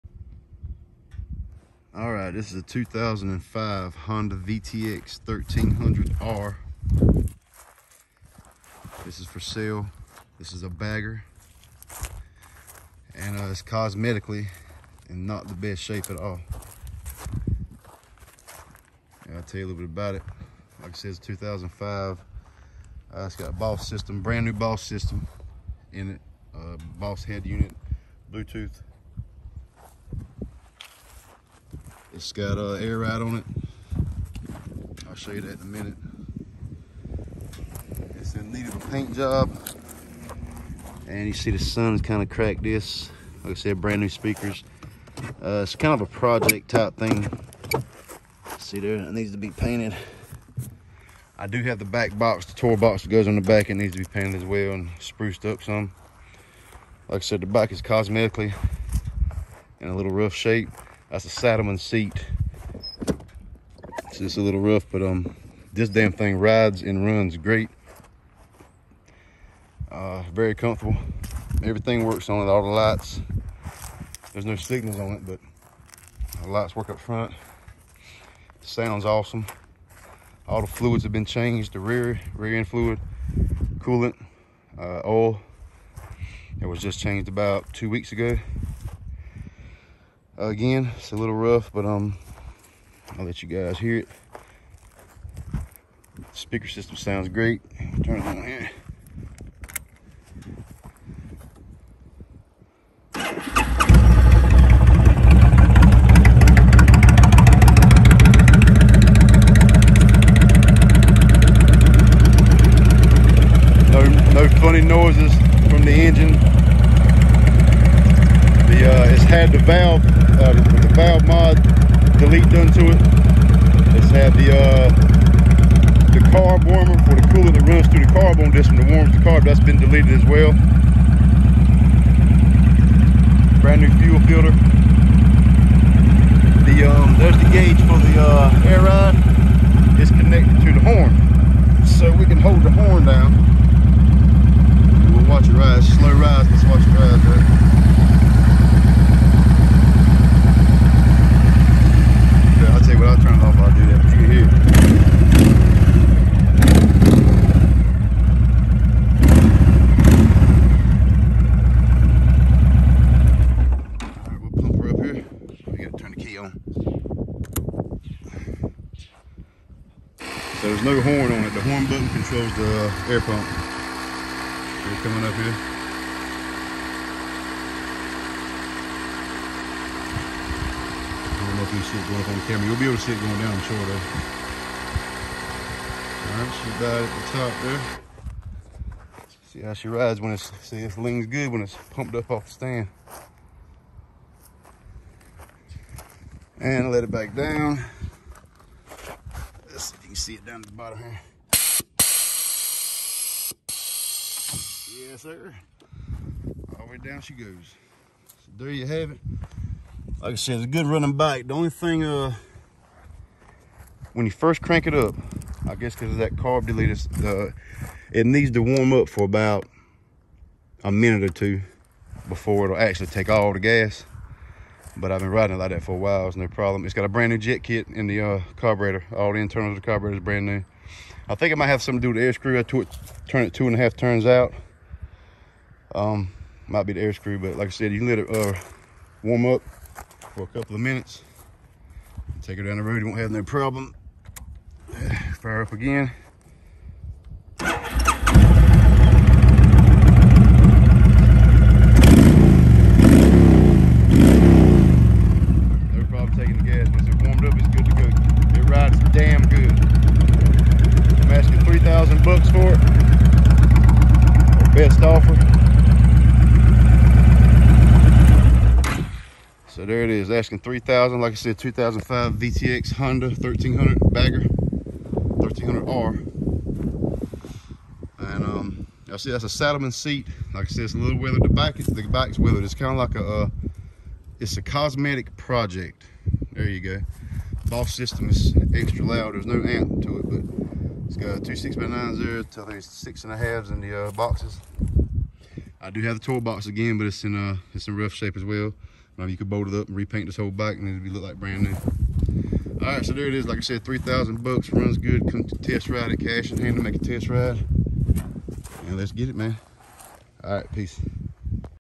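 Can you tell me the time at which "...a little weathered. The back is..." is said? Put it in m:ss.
4:40.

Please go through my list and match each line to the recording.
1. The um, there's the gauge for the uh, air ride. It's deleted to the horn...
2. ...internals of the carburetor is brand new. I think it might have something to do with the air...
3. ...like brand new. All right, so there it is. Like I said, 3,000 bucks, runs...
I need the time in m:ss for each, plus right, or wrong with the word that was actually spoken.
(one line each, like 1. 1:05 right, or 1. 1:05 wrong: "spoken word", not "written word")
1. 2:16 wrong: "connected", not "deleted"
2. 3:49 right
3. 5:01 right.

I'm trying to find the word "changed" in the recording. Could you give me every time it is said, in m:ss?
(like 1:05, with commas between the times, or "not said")
1:21, 1:27.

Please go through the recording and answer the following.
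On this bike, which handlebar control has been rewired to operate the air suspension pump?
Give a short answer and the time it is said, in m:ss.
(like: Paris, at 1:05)
The horn button, at 2:51.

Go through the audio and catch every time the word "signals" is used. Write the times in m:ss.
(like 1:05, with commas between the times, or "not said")
1:14.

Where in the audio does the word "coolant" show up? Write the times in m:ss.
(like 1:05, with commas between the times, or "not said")
1:23, 2:07.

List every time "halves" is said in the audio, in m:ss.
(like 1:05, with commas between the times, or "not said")
4:53.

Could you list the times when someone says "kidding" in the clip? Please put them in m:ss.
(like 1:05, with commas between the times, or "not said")
not said.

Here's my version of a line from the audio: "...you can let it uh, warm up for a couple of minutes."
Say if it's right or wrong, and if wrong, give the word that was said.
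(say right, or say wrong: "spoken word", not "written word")
right.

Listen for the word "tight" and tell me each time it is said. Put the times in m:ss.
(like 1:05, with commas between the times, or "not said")
not said.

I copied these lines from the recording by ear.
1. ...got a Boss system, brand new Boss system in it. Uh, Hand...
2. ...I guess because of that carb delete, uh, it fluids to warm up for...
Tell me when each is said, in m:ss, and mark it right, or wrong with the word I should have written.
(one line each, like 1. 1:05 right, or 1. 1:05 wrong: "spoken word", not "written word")
1. 0:23 wrong: "Boss", not "Hand"
2. 3:35 wrong: "needs", not "fluids".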